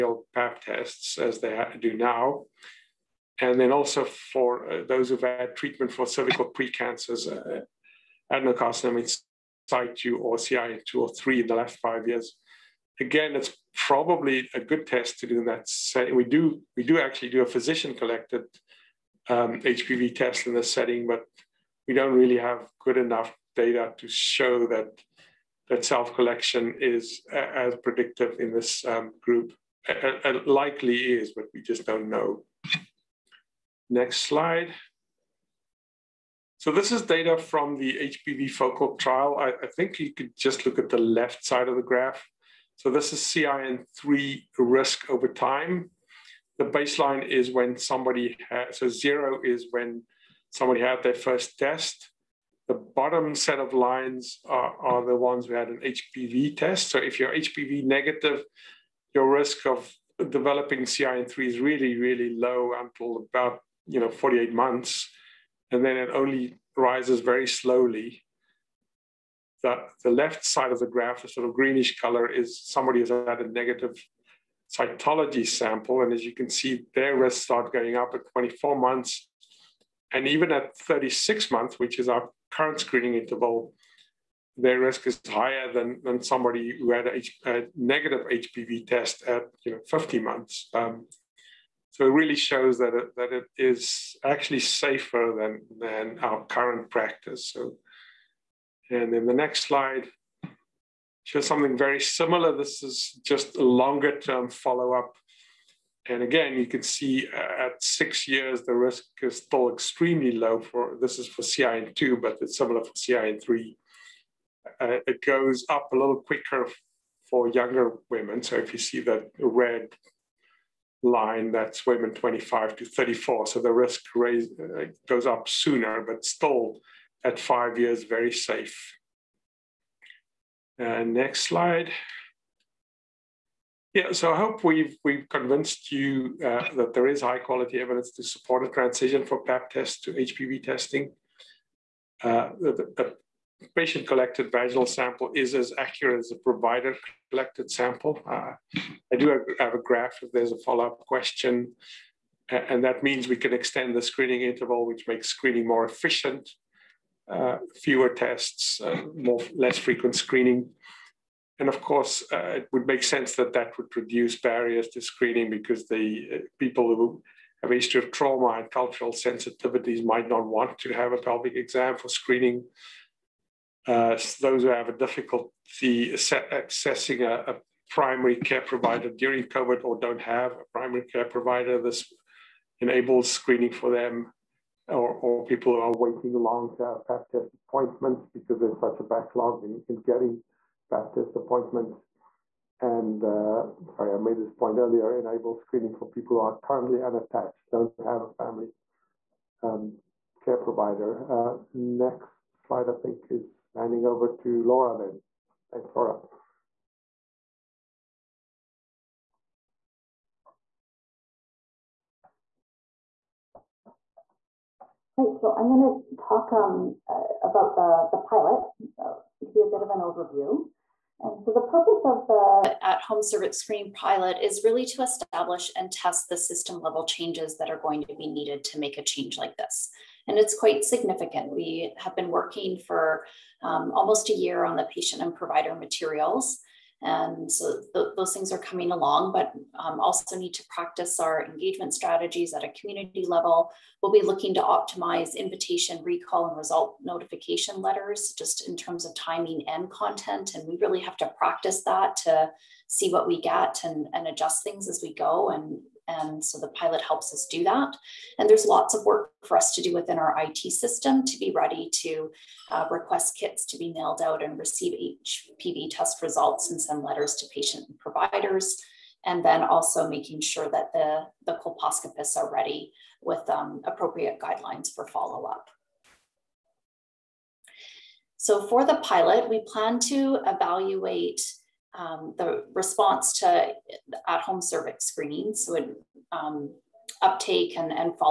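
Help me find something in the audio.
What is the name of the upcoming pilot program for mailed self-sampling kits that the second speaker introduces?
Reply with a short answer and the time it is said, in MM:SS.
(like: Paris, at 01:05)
At-home cervix screen pilot, at 03:42.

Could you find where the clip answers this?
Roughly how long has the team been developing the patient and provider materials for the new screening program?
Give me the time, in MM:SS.
03:53.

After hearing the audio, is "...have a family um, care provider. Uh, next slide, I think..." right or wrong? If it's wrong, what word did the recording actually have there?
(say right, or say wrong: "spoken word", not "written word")
right.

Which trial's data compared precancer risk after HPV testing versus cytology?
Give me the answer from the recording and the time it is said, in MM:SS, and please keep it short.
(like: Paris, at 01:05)
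HPV FOCAL, at 00:38.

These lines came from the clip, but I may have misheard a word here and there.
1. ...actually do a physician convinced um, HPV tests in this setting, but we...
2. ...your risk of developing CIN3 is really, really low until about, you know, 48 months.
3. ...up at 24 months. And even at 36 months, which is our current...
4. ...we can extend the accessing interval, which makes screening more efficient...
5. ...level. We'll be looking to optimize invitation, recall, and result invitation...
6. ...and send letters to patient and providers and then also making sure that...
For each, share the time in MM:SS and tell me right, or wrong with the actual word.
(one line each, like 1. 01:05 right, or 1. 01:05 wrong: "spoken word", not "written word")
1. 00:16 wrong: "collected", not "convinced"
2. 00:59 right
3. 01:17 right
4. 02:33 wrong: "screening", not "accessing"
5. 04:03 wrong: "notification", not "invitation"
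6. 04:26 right.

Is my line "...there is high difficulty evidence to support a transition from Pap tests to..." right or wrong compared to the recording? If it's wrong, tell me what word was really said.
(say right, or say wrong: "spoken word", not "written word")
wrong: "quality", not "difficulty".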